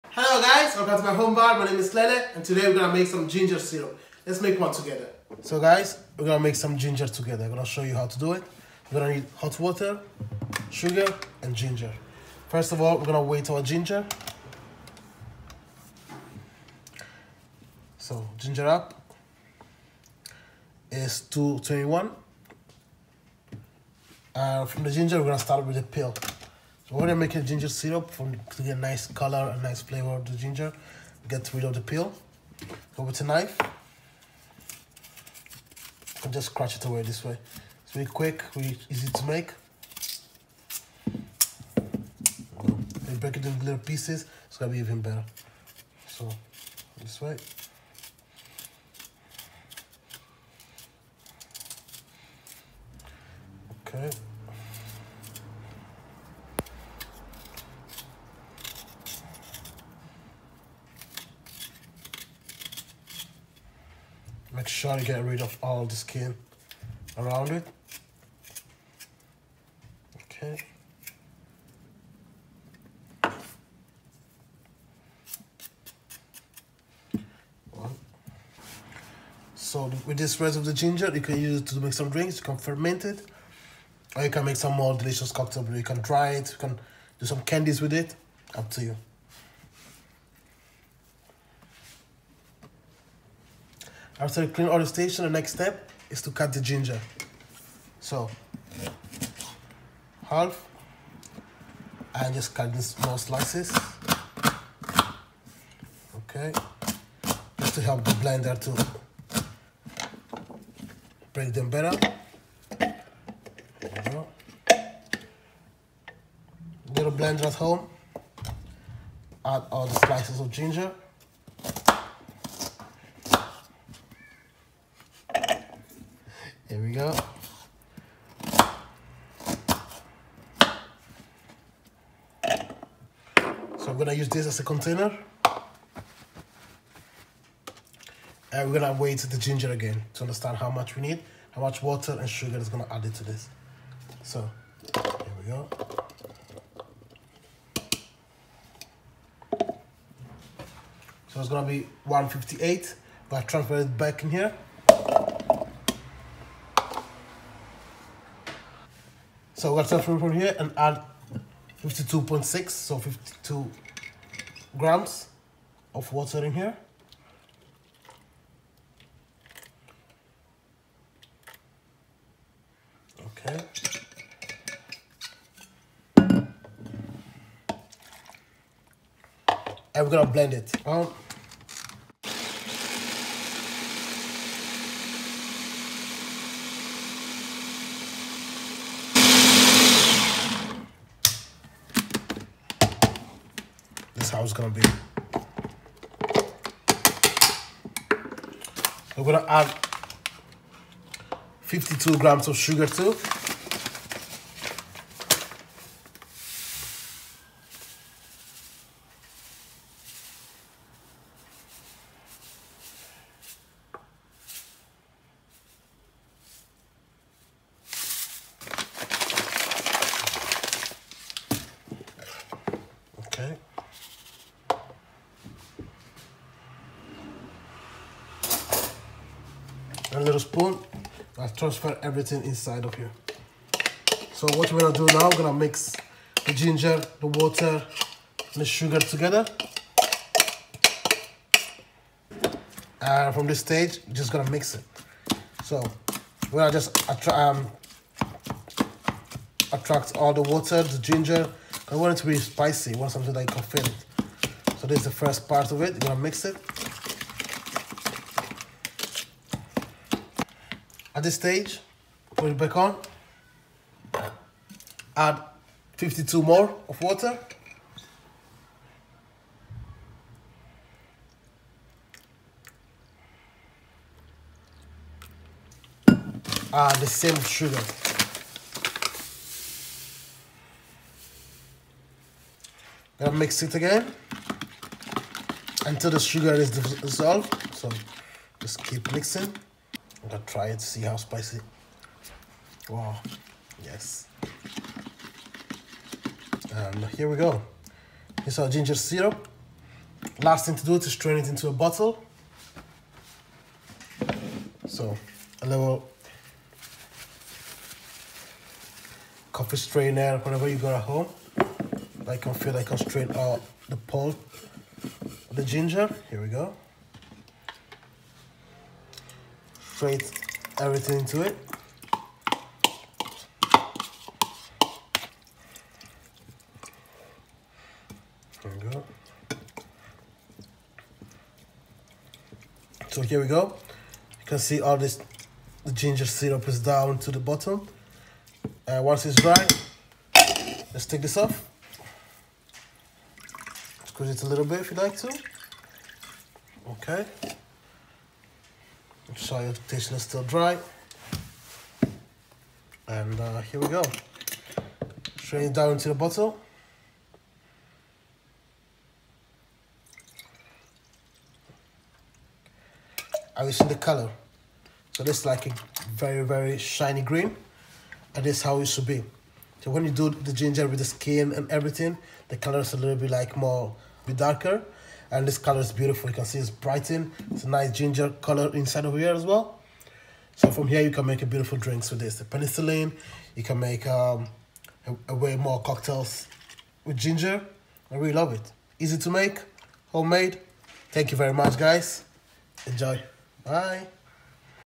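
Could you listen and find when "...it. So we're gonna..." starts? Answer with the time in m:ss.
4:04.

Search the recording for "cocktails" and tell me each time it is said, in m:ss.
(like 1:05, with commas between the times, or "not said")
1:25, 6:25.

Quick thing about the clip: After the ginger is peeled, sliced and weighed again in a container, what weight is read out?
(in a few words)
158.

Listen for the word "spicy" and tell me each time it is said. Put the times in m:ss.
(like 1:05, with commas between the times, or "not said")
4:12, 4:51.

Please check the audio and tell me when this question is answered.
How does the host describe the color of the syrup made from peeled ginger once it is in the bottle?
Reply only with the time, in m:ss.
6:06.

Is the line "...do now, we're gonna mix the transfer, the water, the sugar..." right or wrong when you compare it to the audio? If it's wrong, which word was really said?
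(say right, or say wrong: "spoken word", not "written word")
wrong: "ginger", not "transfer".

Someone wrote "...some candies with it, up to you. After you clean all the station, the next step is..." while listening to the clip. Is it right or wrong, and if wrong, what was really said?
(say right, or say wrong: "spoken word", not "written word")
right.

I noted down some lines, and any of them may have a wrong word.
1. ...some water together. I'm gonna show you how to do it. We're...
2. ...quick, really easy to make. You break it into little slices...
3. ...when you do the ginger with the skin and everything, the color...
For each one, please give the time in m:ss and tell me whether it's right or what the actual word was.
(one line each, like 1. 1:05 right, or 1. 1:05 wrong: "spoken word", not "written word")
1. 0:06 wrong: "ginger", not "water"
2. 0:38 wrong: "pieces", not "slices"
3. 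6:09 right.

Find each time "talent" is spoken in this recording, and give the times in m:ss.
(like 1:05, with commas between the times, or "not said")
not said.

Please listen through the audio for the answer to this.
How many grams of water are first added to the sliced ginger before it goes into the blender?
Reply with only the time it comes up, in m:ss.
2:42.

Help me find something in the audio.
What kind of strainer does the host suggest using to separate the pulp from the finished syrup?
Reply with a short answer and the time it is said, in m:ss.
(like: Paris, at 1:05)
coffee strainer, at 5:09.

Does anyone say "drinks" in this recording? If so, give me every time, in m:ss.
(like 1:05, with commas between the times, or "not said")
1:22, 6:21.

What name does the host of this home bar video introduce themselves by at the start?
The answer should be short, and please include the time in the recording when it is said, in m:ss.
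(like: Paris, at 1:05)
Lele, at 0:01.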